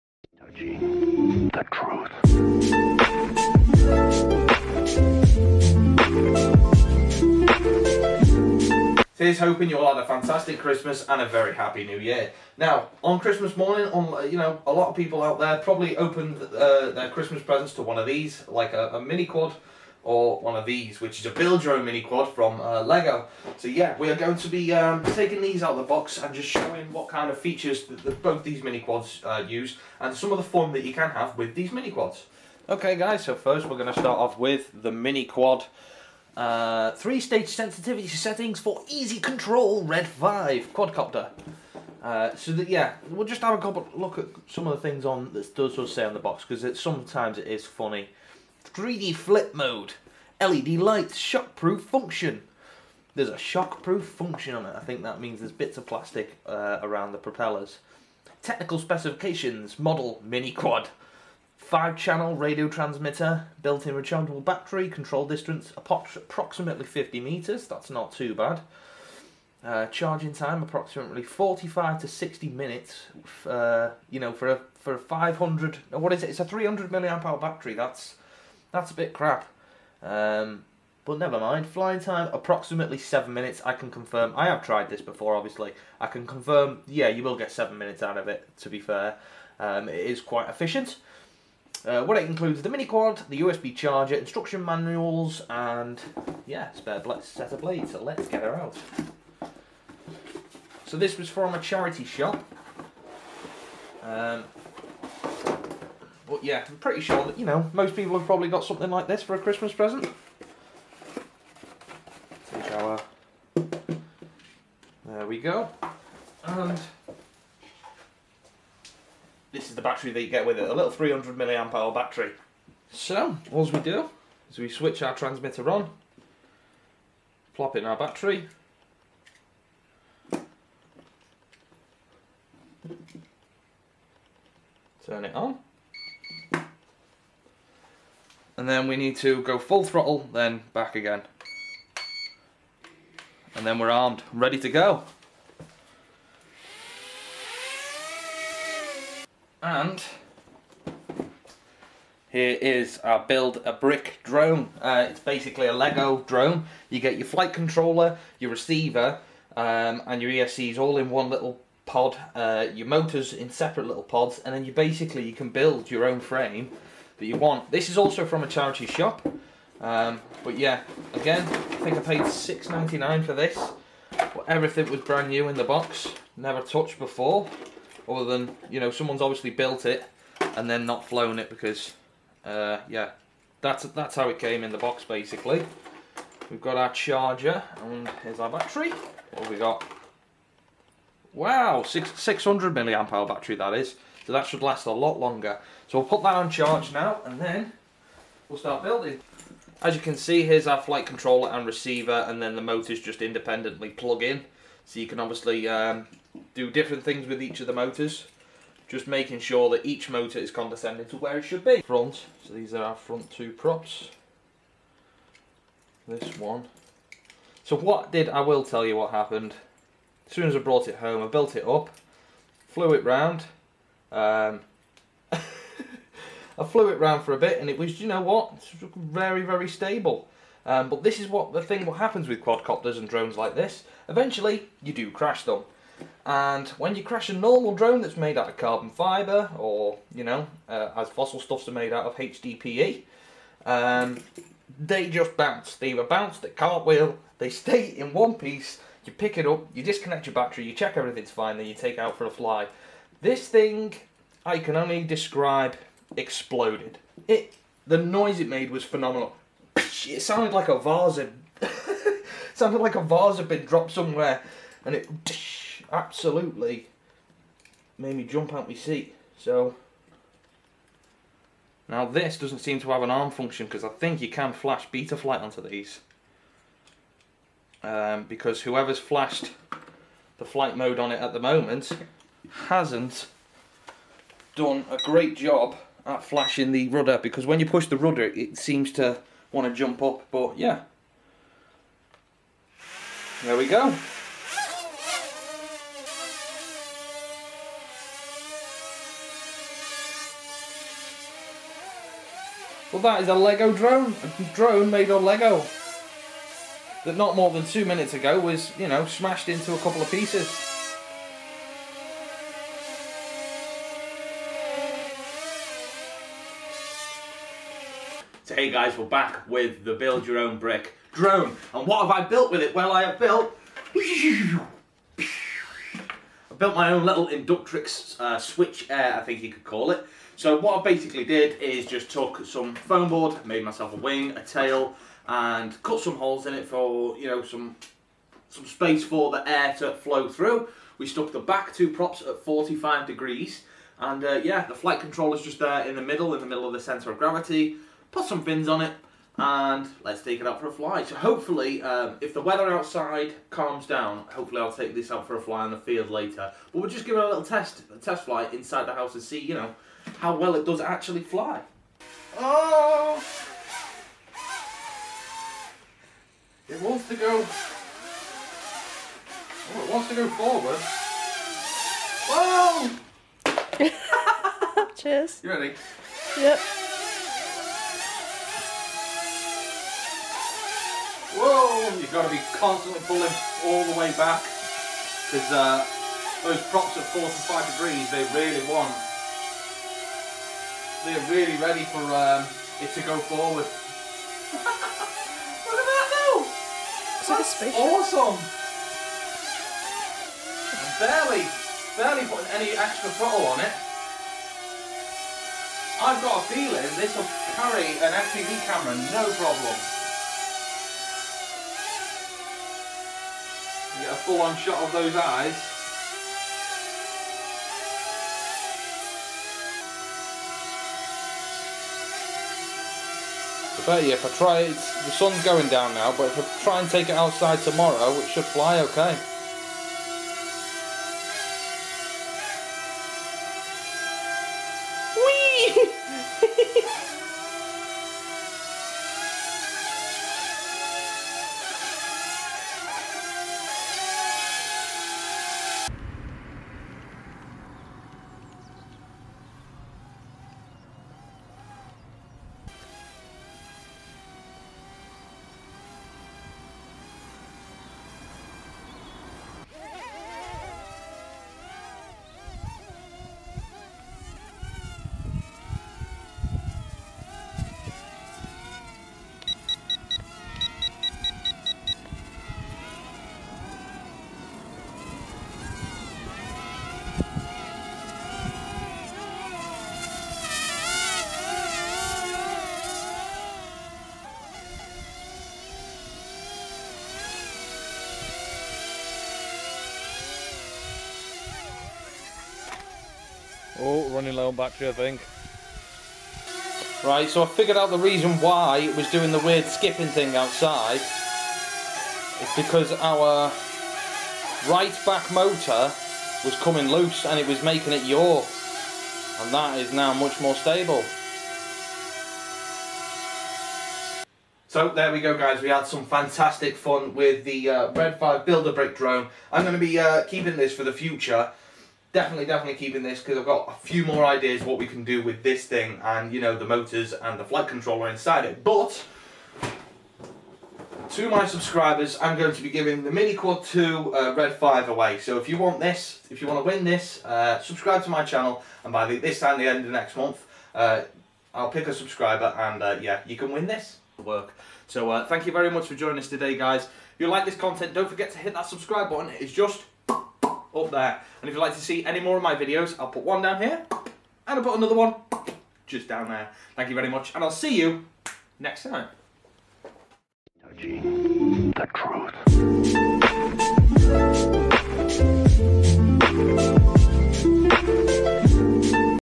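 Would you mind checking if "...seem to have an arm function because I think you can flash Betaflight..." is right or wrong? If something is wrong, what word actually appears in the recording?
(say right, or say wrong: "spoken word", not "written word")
right.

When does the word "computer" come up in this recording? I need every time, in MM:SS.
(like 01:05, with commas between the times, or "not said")
not said.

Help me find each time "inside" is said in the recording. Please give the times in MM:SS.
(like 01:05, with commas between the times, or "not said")
05:58, 08:48.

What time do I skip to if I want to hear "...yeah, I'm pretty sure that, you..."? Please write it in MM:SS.
01:46.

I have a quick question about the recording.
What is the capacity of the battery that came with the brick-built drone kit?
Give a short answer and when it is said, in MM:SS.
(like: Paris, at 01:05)
600 milliamp hour, at 03:12.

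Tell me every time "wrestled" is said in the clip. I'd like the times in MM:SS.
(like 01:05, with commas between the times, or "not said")
not said.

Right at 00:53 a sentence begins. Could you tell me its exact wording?
There's a shockproof function on it.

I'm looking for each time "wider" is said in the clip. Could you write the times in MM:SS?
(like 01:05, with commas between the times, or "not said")
not said.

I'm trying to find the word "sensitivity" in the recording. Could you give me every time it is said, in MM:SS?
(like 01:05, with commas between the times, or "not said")
00:37.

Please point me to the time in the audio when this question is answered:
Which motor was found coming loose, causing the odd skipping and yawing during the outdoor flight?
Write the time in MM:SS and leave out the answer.
08:24.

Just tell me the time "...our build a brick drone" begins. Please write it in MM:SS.
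02:32.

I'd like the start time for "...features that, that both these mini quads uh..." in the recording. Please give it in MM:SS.
00:27.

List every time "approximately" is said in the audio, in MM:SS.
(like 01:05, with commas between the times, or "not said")
01:05, 01:10, 01:22.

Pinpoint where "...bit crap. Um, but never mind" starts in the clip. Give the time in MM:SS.
01:18.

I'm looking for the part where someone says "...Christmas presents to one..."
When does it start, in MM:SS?
00:17.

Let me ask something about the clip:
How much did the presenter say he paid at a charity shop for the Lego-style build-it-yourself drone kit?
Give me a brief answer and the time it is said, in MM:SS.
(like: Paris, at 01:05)
6.99, at 02:52.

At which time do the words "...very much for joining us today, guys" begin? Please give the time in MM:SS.
09:05.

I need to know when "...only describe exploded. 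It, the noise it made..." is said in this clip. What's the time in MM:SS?
04:14.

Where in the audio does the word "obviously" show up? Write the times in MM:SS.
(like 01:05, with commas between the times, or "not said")
01:25, 02:59, 03:25.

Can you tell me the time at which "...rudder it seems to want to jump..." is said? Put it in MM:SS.
04:47.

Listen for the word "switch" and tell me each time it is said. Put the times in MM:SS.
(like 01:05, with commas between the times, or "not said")
02:04, 05:28.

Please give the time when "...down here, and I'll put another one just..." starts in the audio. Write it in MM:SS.
09:13.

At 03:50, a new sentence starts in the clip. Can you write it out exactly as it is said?
Um, but this is what the thing what happens with quadcopters and drones like this.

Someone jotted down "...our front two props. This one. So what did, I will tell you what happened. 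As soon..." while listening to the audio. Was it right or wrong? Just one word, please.
right.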